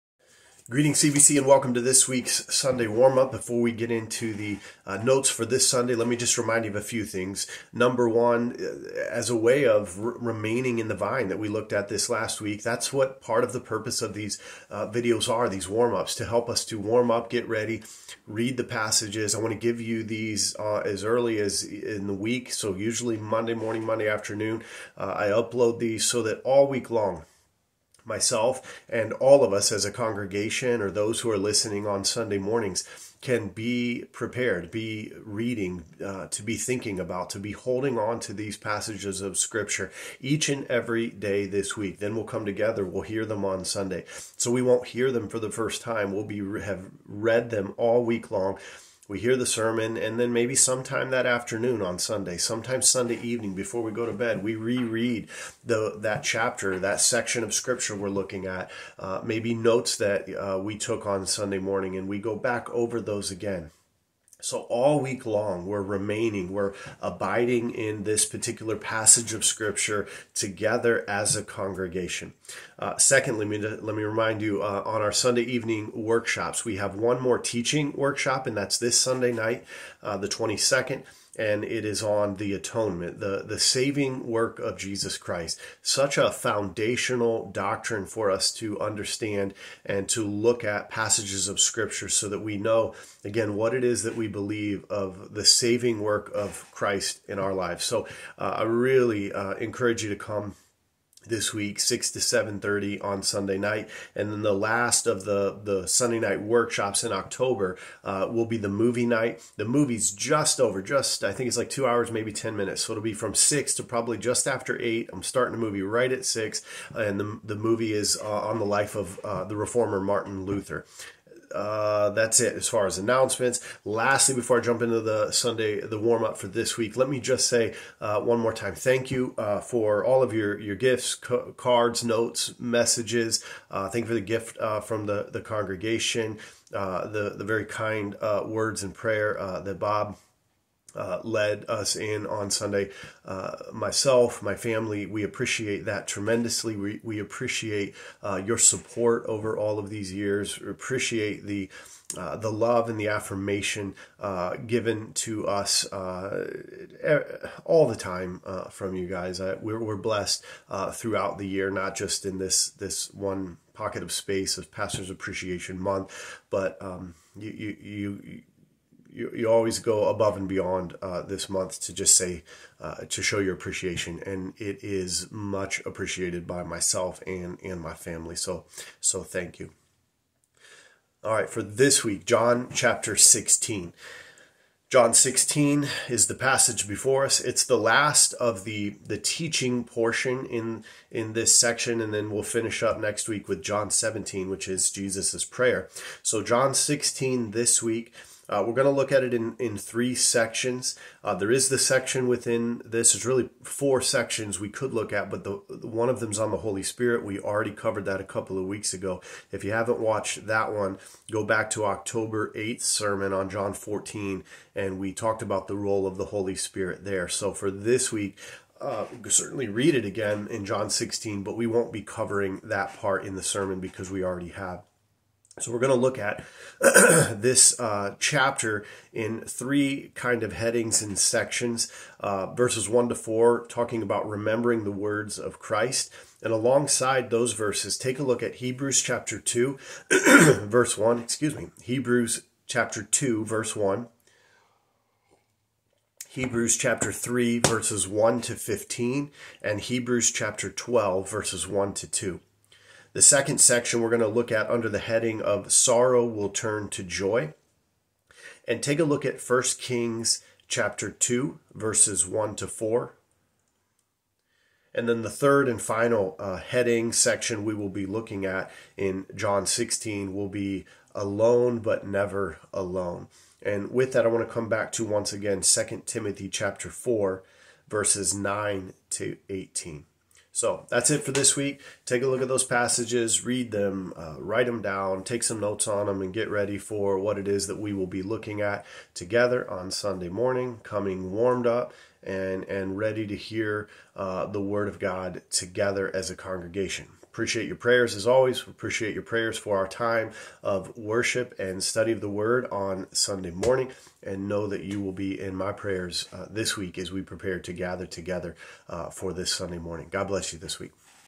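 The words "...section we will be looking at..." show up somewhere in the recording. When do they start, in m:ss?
4:27.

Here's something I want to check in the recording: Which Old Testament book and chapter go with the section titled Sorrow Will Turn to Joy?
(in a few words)
1 Kings 2.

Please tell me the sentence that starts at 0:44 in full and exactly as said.
So we won't hear them for the first time.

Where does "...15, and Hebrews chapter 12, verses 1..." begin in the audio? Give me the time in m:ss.
4:08.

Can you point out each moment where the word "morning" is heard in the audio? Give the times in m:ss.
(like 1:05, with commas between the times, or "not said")
0:23, 0:32, 1:01, 4:50, 5:03, 5:09.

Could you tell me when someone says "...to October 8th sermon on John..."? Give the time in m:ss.
3:31.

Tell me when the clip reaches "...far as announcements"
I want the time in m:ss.
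2:02.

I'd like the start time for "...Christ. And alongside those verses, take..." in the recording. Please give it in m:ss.
3:55.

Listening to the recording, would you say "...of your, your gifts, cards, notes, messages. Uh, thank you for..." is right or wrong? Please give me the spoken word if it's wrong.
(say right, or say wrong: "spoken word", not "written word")
right.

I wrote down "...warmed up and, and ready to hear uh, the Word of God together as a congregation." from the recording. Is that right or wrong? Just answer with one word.
right.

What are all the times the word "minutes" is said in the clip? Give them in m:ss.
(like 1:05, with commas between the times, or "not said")
1:52.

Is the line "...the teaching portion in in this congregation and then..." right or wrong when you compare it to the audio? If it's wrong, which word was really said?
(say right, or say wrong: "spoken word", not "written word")
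wrong: "section", not "congregation".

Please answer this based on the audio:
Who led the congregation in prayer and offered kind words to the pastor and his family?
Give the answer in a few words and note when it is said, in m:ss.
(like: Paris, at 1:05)
Bob, at 2:19.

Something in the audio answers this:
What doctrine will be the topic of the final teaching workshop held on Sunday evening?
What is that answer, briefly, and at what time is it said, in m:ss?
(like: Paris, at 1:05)
The atonement, at 1:22.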